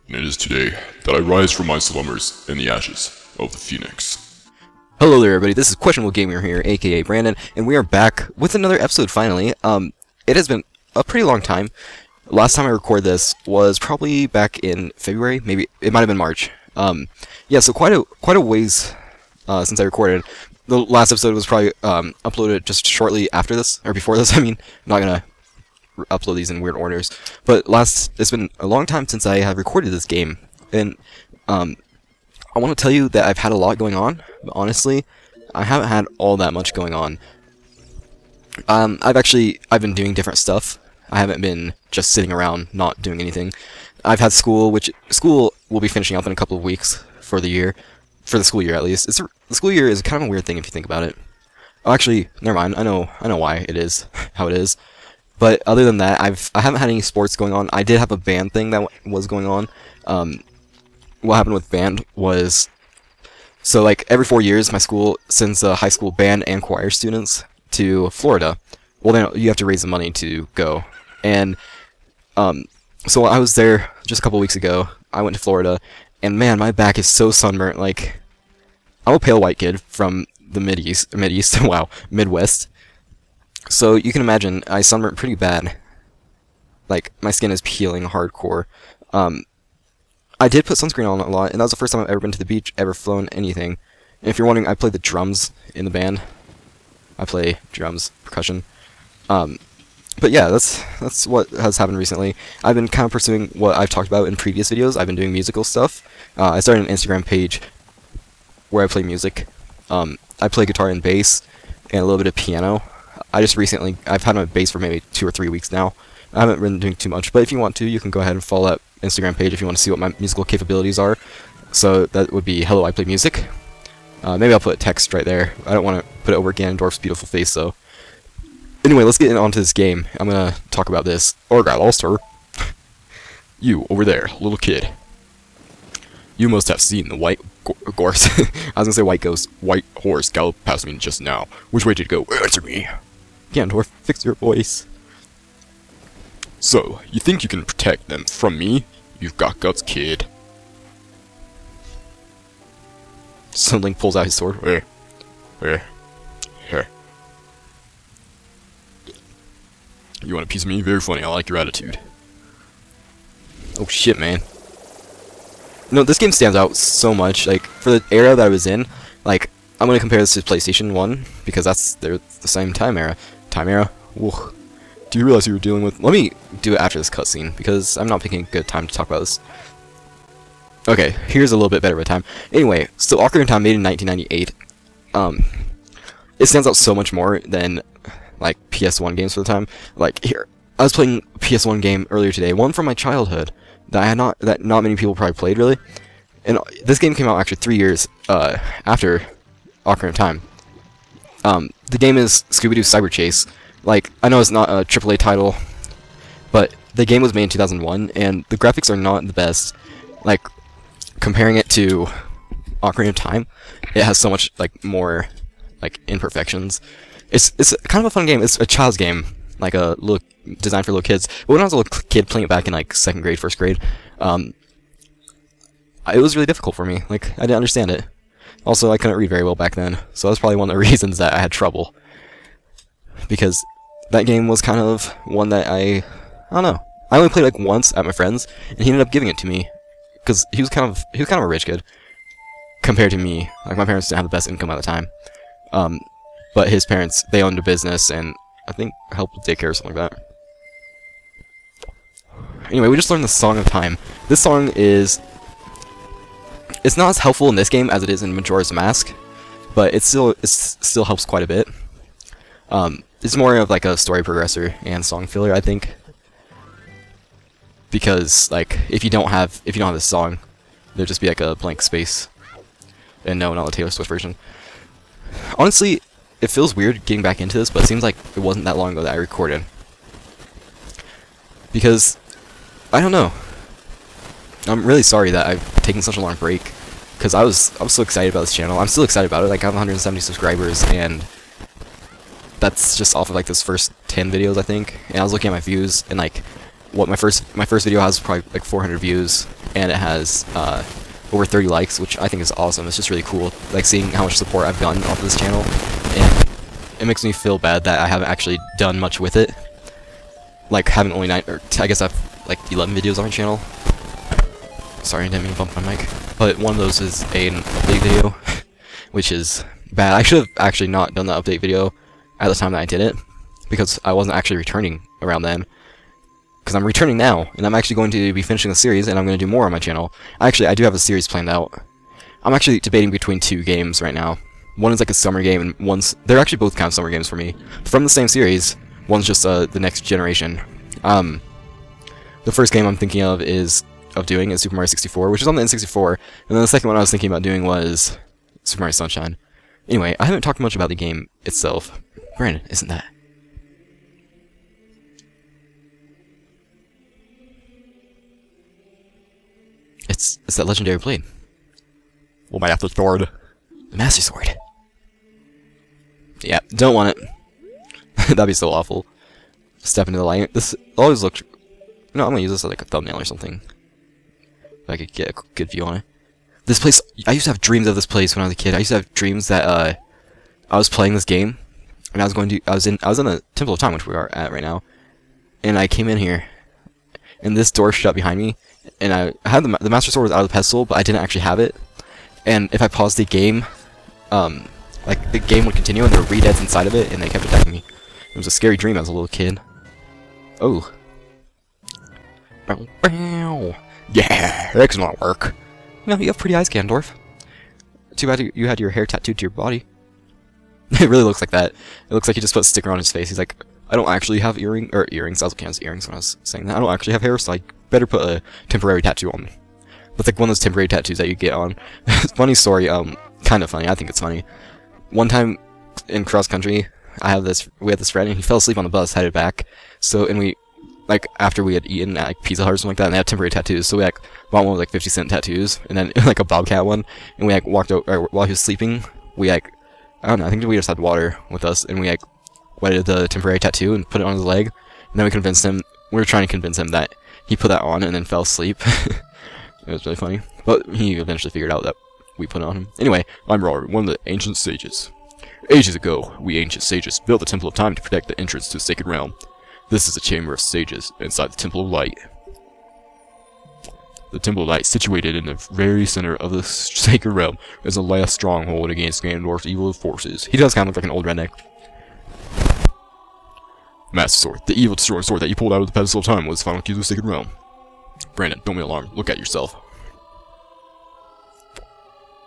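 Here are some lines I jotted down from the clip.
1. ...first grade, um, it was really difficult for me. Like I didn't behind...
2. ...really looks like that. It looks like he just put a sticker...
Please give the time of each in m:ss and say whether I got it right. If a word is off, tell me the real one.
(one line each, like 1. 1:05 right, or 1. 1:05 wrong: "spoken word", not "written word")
1. 3:43 wrong: "understand", not "behind"
2. 6:51 right.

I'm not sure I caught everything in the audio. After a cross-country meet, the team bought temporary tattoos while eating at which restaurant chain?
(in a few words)
Pizza Hut.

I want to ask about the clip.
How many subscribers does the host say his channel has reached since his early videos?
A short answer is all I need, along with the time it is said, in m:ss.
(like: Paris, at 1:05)
170, at 4:49.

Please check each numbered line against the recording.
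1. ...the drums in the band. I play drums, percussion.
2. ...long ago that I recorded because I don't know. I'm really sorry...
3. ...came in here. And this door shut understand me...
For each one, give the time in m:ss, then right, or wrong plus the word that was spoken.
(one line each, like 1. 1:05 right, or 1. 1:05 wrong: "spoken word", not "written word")
1. 1:34 right
2. 4:38 right
3. 6:25 wrong: "behind", not "understand".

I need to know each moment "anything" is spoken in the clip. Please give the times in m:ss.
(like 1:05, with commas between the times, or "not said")
0:43, 1:33.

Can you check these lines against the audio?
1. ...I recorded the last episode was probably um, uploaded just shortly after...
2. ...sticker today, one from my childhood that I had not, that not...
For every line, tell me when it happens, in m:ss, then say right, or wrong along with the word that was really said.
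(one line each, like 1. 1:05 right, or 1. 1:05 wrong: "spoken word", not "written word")
1. 0:19 right
2. 3:12 wrong: "earlier", not "sticker".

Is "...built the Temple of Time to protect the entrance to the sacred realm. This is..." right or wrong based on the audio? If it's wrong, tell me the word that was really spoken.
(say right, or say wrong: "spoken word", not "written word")
right.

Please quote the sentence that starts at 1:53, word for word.
I just recently I've had my bass for maybe two or three weeks now.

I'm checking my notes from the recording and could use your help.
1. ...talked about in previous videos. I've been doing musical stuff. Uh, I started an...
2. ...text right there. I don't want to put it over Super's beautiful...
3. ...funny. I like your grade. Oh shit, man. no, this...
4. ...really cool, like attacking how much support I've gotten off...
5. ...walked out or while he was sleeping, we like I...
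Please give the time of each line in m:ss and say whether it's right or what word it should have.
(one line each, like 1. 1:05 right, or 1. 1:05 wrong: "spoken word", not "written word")
1. 1:43 right
2. 2:04 wrong: "Ganondorf", not "Super"
3. 2:40 wrong: "attitude", not "grade"
4. 5:03 wrong: "seeing", not "attacking"
5. 7:17 right.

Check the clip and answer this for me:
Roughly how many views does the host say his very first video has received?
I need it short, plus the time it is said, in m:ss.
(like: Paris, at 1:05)
400, at 4:58.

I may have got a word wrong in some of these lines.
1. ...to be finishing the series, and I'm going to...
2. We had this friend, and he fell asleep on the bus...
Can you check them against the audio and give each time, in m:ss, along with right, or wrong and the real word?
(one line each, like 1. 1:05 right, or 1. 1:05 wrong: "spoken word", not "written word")
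1. 5:28 right
2. 7:07 right.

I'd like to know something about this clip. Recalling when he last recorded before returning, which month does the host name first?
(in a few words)
February.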